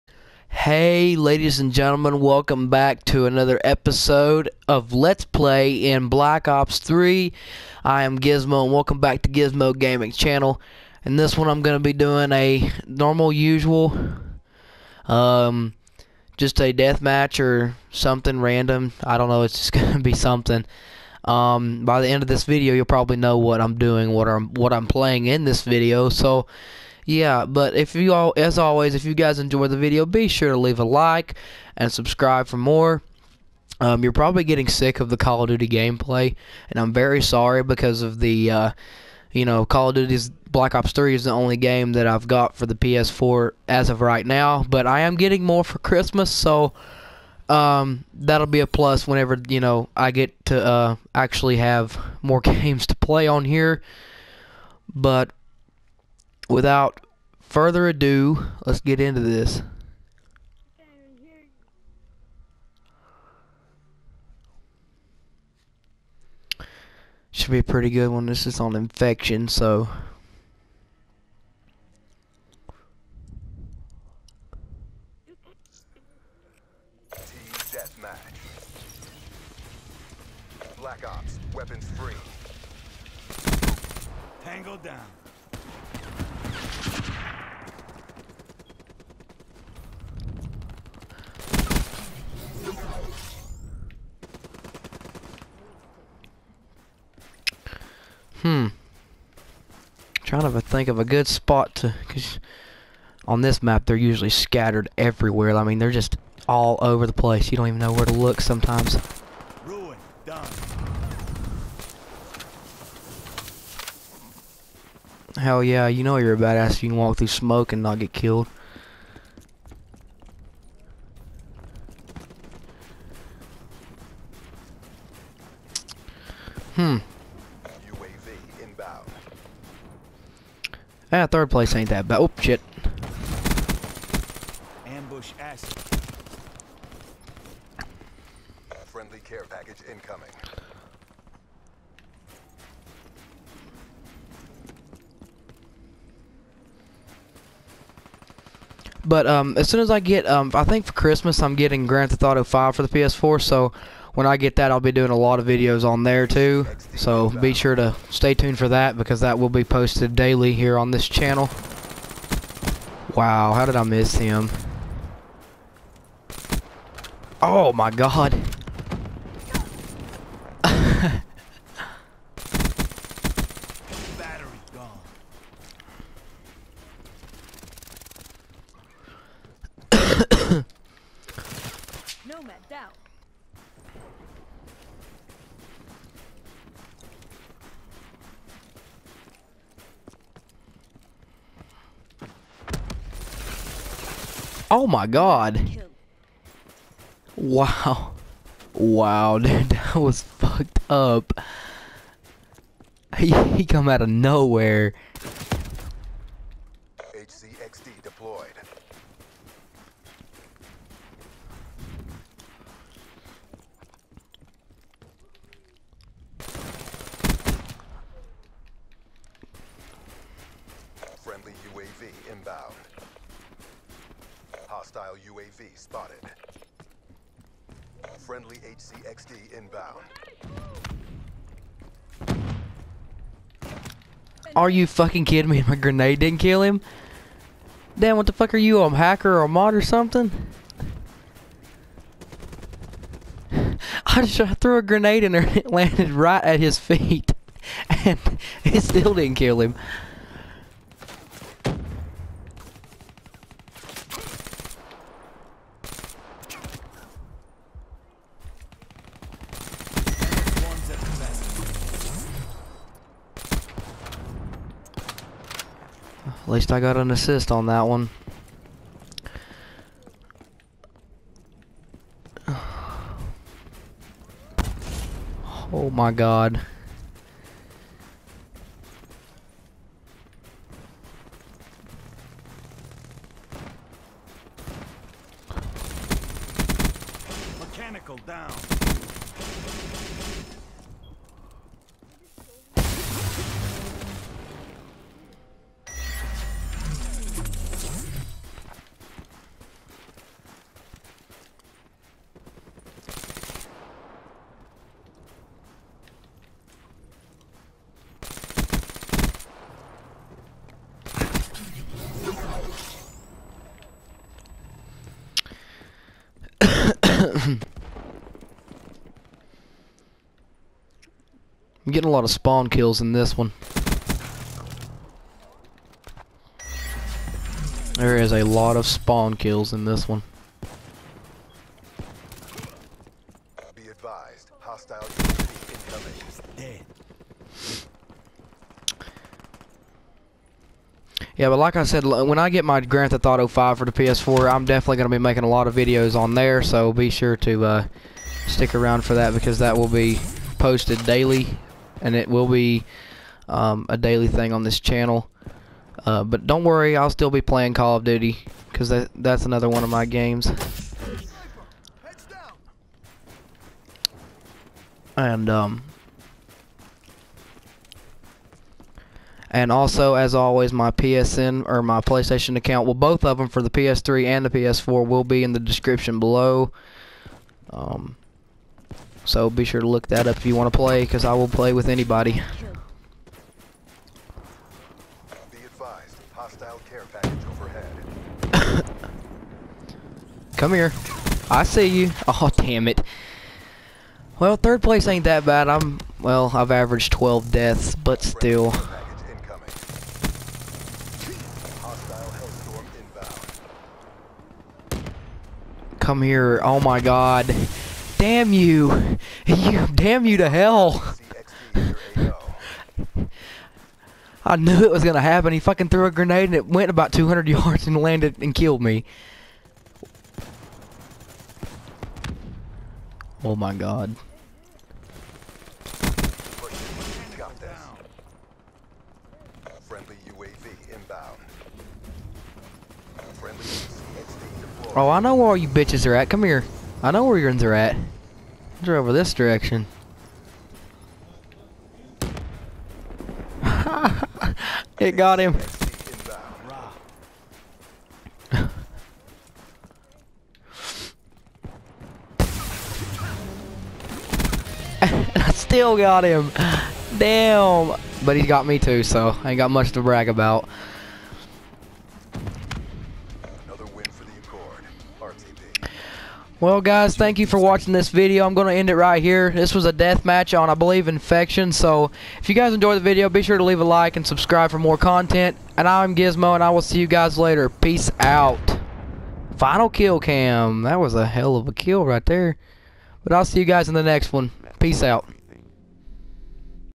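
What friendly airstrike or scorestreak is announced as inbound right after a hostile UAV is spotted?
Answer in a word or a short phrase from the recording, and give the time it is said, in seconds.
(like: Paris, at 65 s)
HCXD, at 228 s.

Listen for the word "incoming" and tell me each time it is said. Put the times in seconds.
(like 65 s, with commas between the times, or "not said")
139 s, 335 s.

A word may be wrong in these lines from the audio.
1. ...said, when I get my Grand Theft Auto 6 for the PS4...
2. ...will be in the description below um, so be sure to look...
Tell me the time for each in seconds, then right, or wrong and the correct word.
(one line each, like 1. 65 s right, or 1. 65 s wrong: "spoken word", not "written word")
1. 341 s wrong: "5", not "6"
2. 375 s right.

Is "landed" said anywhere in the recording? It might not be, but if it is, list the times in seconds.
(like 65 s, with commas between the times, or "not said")
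245 s, 417 s.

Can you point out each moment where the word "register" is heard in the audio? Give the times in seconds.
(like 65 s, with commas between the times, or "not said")
not said.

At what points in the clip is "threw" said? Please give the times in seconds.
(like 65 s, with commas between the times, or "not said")
244 s, 415 s.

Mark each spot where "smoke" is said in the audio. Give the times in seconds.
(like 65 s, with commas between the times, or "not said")
117 s.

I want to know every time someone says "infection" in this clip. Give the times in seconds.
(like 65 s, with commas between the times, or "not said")
68 s, 471 s.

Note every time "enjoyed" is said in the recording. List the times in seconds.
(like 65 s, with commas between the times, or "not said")
29 s, 472 s.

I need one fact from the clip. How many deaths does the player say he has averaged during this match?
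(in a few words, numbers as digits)
12.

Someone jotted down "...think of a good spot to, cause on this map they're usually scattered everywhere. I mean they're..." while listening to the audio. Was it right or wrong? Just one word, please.
right.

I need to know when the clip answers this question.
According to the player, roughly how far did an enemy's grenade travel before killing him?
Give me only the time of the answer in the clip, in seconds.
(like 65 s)
417 s.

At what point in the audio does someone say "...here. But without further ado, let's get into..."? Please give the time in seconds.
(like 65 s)
53 s.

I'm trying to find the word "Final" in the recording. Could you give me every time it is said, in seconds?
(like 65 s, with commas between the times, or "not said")
479 s.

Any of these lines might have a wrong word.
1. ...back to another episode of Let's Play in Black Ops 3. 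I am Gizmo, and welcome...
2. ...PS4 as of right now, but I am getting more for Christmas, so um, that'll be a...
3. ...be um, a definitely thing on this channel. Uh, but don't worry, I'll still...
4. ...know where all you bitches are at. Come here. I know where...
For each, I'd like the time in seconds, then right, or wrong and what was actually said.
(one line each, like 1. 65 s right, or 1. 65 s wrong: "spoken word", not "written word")
1. 2 s right
2. 42 s right
3. 352 s wrong: "daily", not "definitely"
4. 435 s right.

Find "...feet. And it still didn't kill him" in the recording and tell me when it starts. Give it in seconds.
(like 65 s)
246 s.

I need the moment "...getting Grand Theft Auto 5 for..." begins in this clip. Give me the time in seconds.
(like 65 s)
151 s.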